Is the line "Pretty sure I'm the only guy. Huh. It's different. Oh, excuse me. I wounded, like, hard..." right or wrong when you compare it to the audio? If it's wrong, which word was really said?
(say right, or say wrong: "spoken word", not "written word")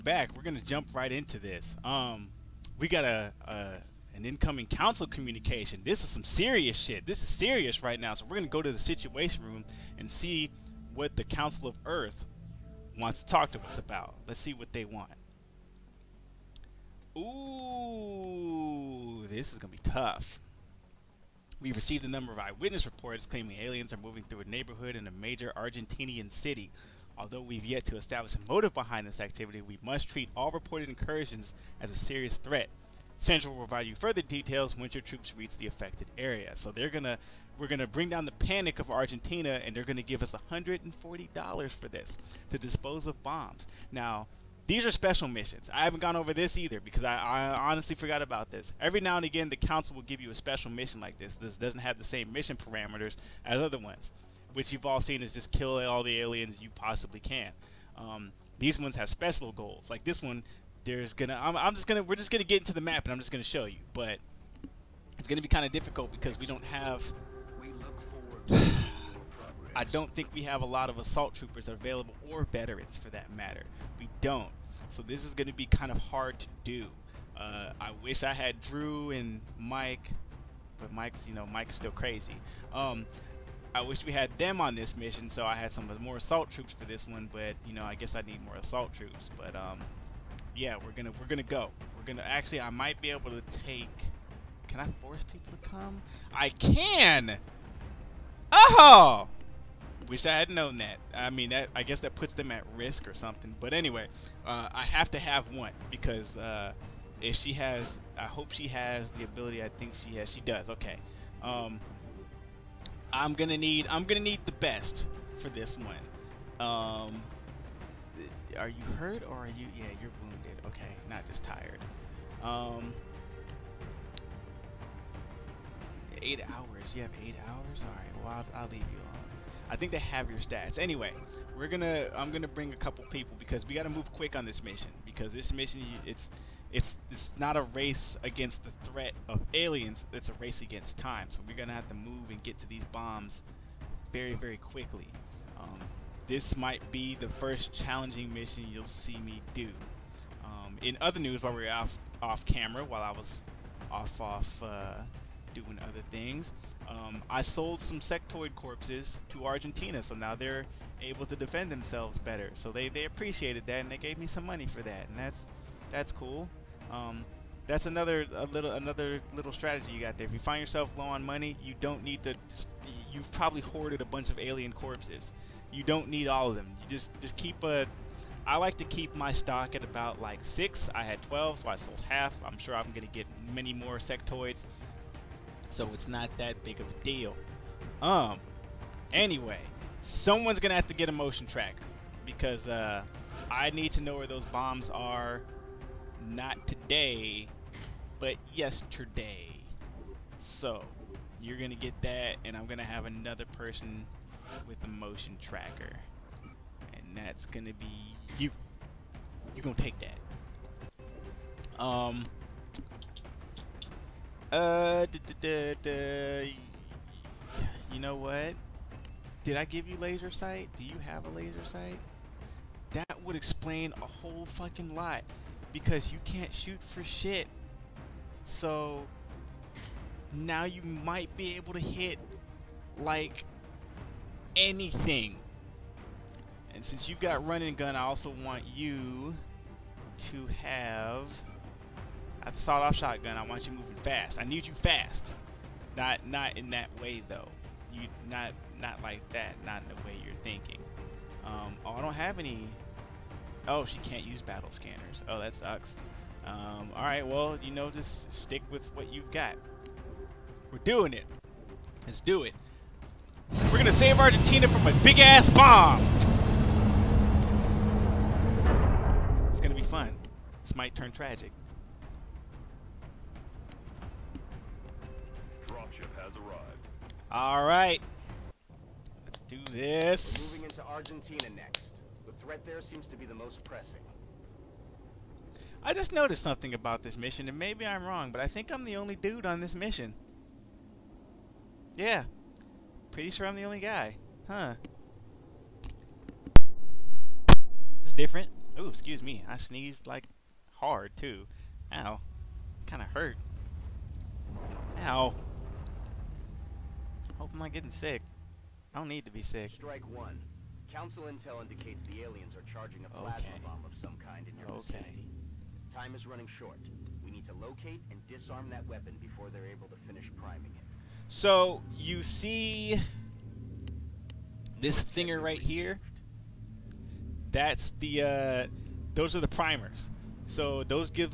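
wrong: "sneezed", not "wounded".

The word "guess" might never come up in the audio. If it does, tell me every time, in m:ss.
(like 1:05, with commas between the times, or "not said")
1:27, 1:41.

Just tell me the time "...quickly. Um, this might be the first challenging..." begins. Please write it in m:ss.
2:24.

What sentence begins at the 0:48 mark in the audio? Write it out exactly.
Every now and again, the council will give you a special mission like this.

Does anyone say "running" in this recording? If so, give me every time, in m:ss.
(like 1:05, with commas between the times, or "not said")
3:57, 5:16.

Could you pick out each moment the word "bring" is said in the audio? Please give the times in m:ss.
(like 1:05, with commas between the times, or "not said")
0:37, 2:12.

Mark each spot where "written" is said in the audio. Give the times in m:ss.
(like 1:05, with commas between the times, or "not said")
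not said.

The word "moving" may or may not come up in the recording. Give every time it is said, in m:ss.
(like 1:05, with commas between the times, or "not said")
0:23, 4:03, 4:40.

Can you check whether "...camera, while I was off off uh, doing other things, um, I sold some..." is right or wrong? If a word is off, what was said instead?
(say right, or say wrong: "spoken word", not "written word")
right.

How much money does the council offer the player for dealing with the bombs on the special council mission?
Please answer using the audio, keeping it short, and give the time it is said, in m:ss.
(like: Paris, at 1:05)
$140, at 0:40.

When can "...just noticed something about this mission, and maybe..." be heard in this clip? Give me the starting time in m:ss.
4:45.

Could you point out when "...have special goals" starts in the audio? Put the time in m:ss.
0:58.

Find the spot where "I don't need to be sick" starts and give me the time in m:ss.
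5:08.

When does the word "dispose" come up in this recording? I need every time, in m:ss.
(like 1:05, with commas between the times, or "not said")
0:42.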